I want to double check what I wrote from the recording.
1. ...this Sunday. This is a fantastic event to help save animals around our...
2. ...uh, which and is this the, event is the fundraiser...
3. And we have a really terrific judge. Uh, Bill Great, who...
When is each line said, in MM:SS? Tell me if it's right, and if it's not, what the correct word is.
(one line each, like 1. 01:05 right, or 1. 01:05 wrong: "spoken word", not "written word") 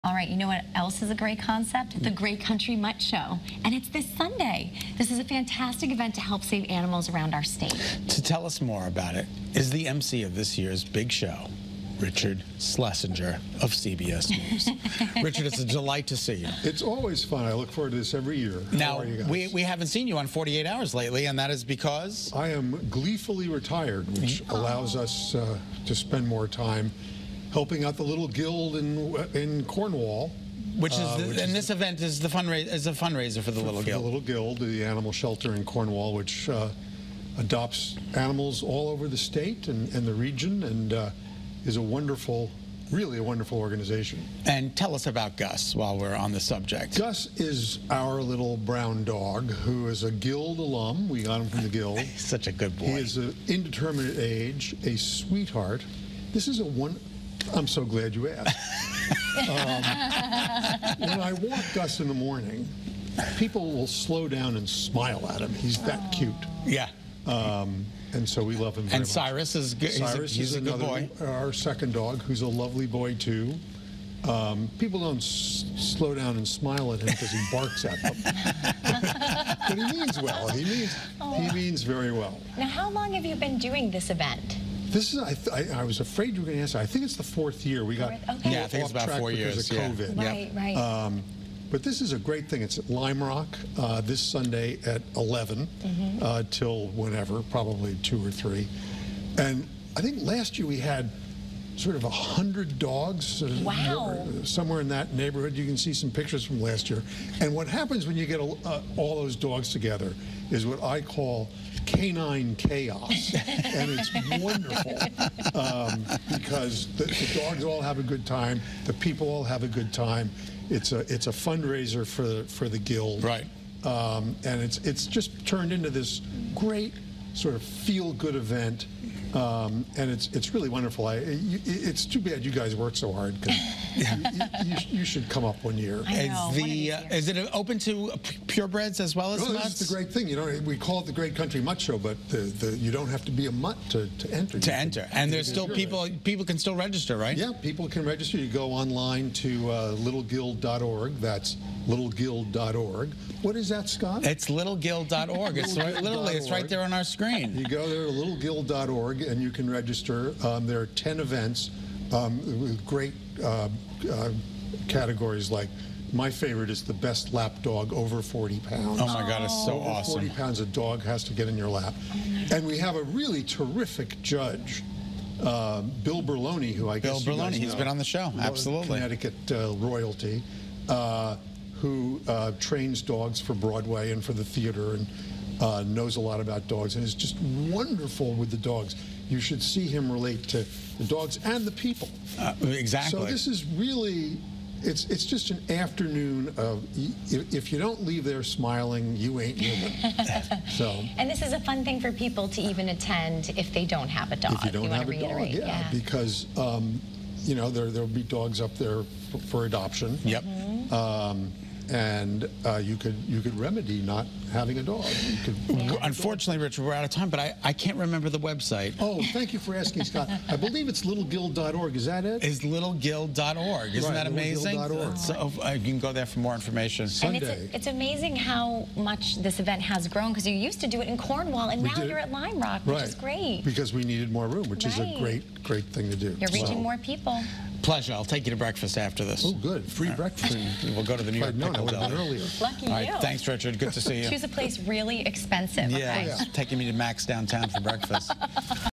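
1. 00:03 right
2. 00:30 right
3. 02:52 wrong: "Berloni", not "Great".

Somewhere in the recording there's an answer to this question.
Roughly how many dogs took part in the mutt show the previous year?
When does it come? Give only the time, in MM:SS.
01:42.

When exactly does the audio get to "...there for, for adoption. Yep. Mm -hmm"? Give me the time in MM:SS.
03:28.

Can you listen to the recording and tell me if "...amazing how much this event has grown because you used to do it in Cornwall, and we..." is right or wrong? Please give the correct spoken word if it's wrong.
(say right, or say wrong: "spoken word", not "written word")
right.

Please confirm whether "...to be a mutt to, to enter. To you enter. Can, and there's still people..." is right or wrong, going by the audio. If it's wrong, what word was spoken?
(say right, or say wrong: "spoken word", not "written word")
right.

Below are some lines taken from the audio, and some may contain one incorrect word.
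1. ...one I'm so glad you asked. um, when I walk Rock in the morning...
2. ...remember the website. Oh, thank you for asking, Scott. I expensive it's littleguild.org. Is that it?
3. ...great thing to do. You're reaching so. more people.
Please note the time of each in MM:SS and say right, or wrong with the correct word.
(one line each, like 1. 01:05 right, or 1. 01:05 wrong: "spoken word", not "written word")
1. 00:56 wrong: "Gus", not "Rock"
2. 03:37 wrong: "believe", not "expensive"
3. 03:55 right.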